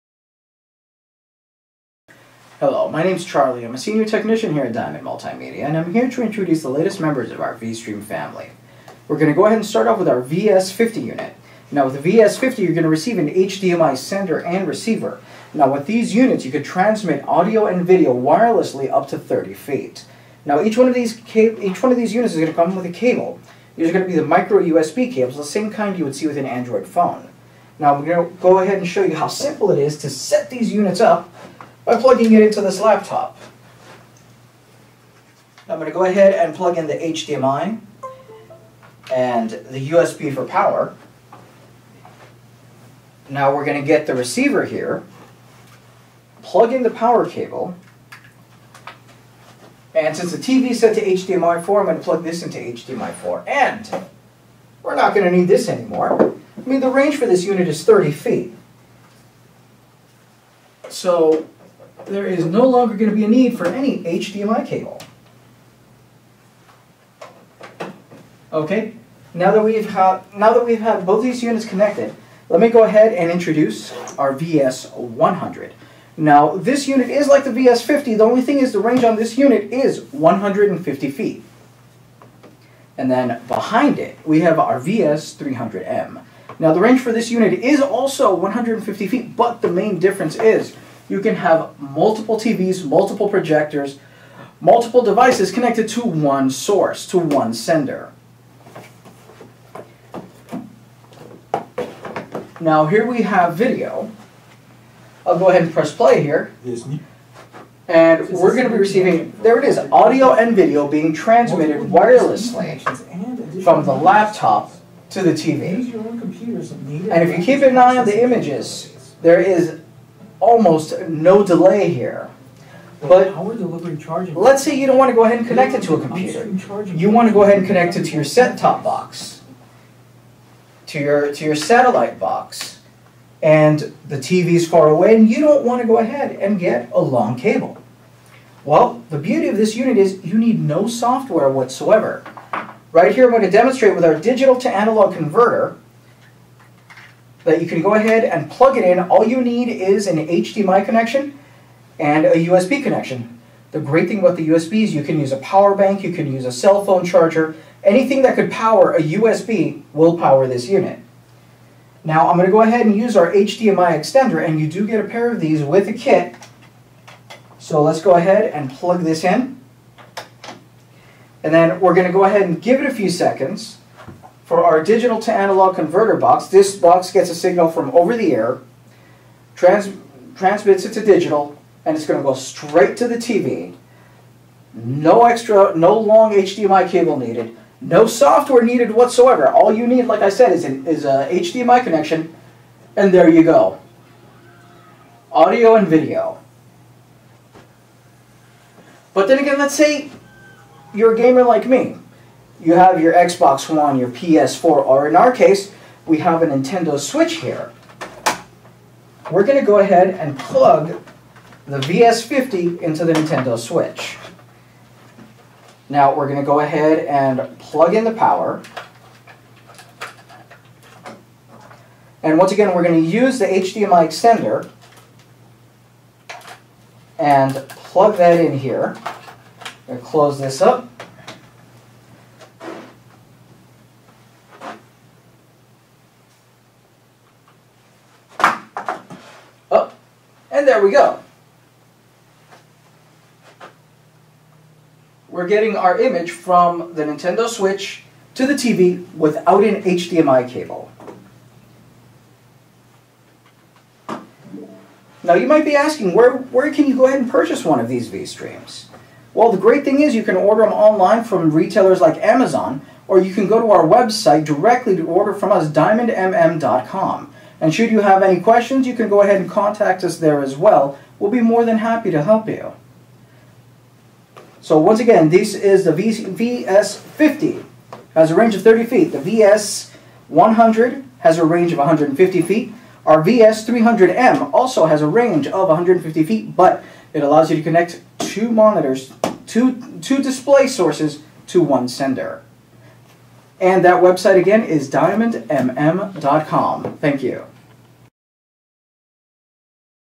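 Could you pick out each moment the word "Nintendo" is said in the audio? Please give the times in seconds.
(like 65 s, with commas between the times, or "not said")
206 s, 213 s, 247 s.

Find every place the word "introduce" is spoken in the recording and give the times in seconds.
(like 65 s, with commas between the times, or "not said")
6 s, 73 s.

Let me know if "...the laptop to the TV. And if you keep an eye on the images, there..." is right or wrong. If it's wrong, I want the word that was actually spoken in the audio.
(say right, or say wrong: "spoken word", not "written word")
right.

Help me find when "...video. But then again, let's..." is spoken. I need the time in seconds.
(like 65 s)
195 s.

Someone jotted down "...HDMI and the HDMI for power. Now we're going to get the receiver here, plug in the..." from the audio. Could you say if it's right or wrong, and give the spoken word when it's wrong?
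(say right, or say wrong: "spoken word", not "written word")
wrong: "USB", not "HDMI".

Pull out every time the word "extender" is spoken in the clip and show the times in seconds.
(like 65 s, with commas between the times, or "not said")
163 s, 224 s.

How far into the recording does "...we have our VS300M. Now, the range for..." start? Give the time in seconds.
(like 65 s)
84 s.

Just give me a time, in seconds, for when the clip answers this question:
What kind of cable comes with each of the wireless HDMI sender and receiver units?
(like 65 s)
24 s.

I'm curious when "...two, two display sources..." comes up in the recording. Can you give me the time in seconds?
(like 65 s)
289 s.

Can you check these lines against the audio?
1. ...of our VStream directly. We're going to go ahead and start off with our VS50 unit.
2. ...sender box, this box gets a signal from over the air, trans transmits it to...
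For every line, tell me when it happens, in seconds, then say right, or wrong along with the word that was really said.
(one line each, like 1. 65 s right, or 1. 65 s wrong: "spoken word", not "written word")
1. 7 s wrong: "family", not "directly"
2. 175 s wrong: "converter", not "sender".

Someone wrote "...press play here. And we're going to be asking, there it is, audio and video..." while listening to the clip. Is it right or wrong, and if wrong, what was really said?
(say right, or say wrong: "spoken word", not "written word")
wrong: "receiving", not "asking".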